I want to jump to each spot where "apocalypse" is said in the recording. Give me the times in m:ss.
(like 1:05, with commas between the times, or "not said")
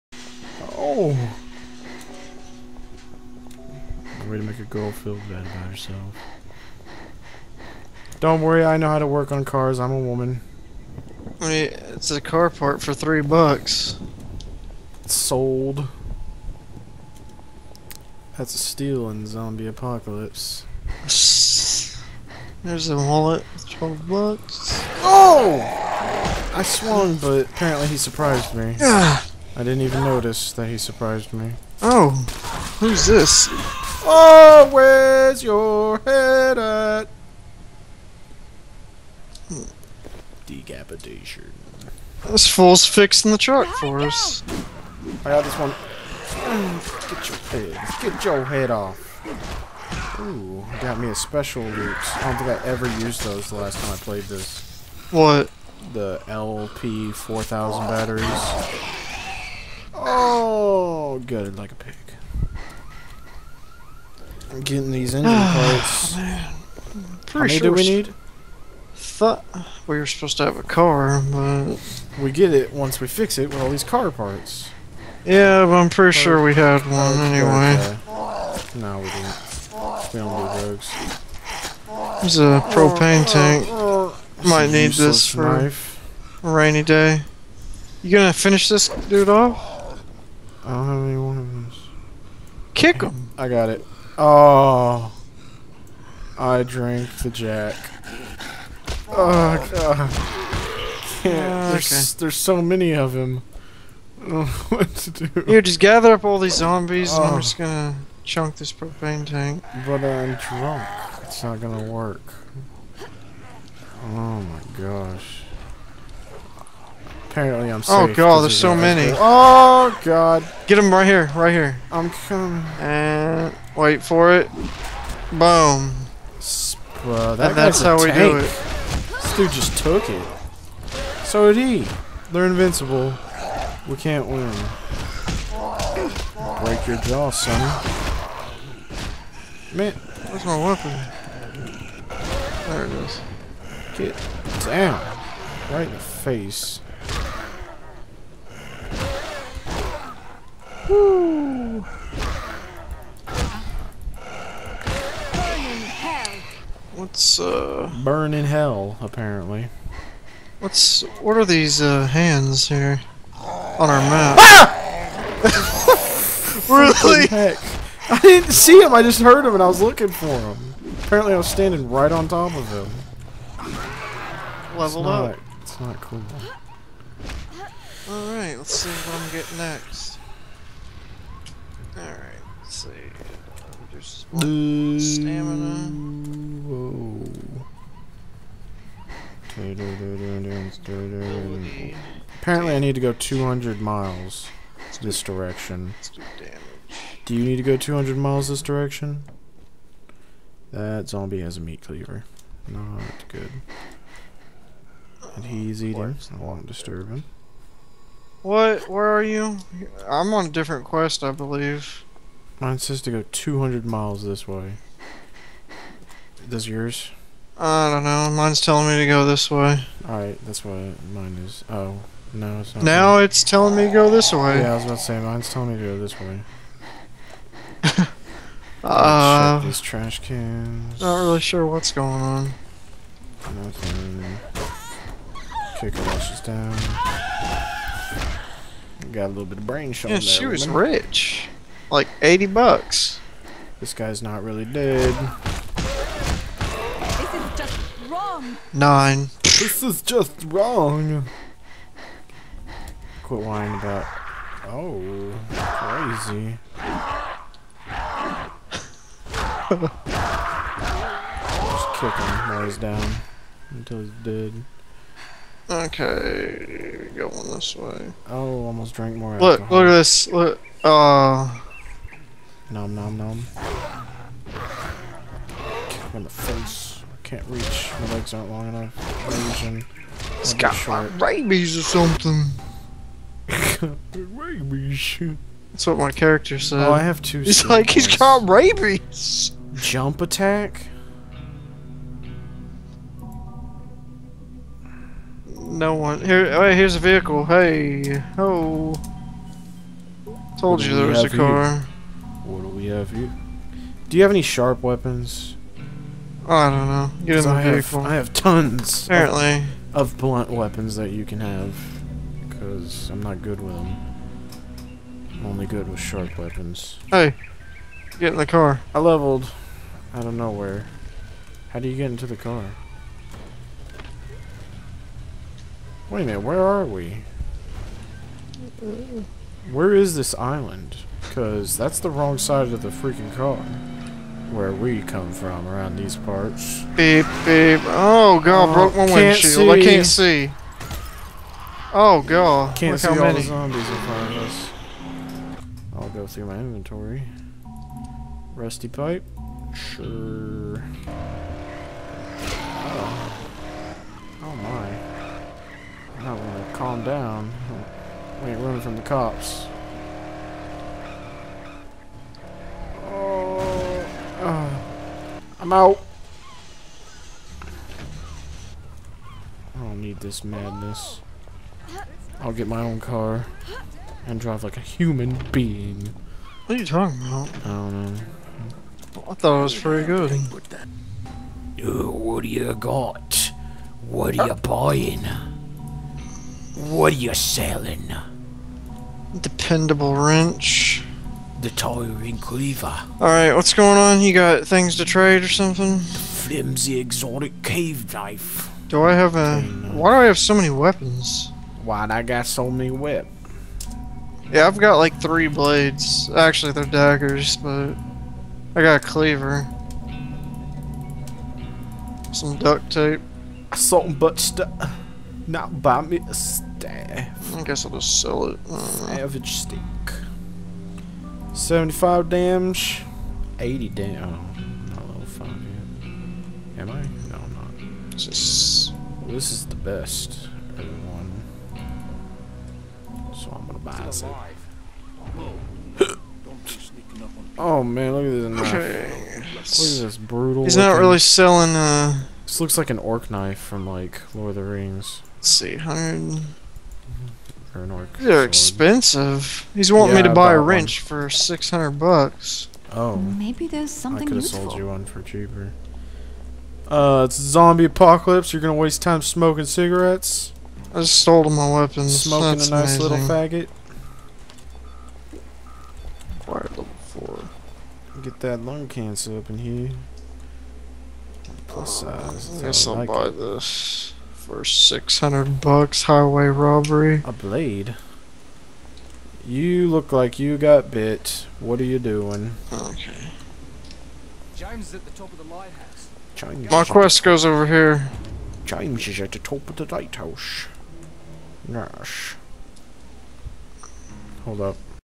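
0:19, 7:37.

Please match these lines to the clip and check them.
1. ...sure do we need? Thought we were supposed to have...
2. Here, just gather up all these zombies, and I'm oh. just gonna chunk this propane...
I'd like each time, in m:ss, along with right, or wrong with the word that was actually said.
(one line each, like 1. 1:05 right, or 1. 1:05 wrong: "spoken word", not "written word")
1. 1:07 right
2. 1:45 right.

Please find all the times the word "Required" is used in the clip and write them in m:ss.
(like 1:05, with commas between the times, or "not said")
7:46.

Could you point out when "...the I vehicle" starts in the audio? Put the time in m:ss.
5:07.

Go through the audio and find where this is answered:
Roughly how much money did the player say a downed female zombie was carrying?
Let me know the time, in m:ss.
4:02.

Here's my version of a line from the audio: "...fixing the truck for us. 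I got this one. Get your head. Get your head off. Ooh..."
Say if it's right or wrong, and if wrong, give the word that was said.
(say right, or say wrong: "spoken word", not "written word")
right.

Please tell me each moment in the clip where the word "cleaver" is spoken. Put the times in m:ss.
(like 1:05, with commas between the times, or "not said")
3:21, 6:32, 6:49.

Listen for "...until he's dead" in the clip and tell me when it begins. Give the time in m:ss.
4:23.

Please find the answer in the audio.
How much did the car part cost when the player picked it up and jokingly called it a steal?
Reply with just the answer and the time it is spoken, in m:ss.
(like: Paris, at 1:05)
3 bucks, at 0:12.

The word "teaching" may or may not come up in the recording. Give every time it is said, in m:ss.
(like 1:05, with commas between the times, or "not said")
not said.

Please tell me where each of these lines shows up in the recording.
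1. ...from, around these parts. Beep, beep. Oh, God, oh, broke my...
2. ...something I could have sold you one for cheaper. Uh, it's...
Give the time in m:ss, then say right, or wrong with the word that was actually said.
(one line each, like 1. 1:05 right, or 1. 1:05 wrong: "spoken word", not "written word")
1. 5:35 right
2. 7:33 right.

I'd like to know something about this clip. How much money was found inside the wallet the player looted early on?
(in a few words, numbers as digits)
12 bucks.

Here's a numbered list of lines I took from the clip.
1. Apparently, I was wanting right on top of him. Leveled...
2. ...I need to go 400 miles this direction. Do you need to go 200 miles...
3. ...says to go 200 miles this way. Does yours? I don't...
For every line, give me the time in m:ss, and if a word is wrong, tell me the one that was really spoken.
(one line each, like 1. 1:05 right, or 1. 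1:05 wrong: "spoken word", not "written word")
1. 2:51 wrong: "standing", not "wanting"
2. 3:12 wrong: "200", not "400"
3. 3:32 right.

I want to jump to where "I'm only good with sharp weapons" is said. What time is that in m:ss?
5:15.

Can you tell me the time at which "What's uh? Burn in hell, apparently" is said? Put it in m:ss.
2:36.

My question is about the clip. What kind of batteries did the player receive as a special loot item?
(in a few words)
LP 4000 batteries.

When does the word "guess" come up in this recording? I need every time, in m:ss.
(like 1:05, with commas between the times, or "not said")
6:57, 7:52.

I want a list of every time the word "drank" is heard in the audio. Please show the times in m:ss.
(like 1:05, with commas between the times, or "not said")
1:36, 4:28.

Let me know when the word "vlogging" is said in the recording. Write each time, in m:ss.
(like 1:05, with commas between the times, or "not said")
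not said.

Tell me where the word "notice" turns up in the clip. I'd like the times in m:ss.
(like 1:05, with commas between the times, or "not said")
0:30.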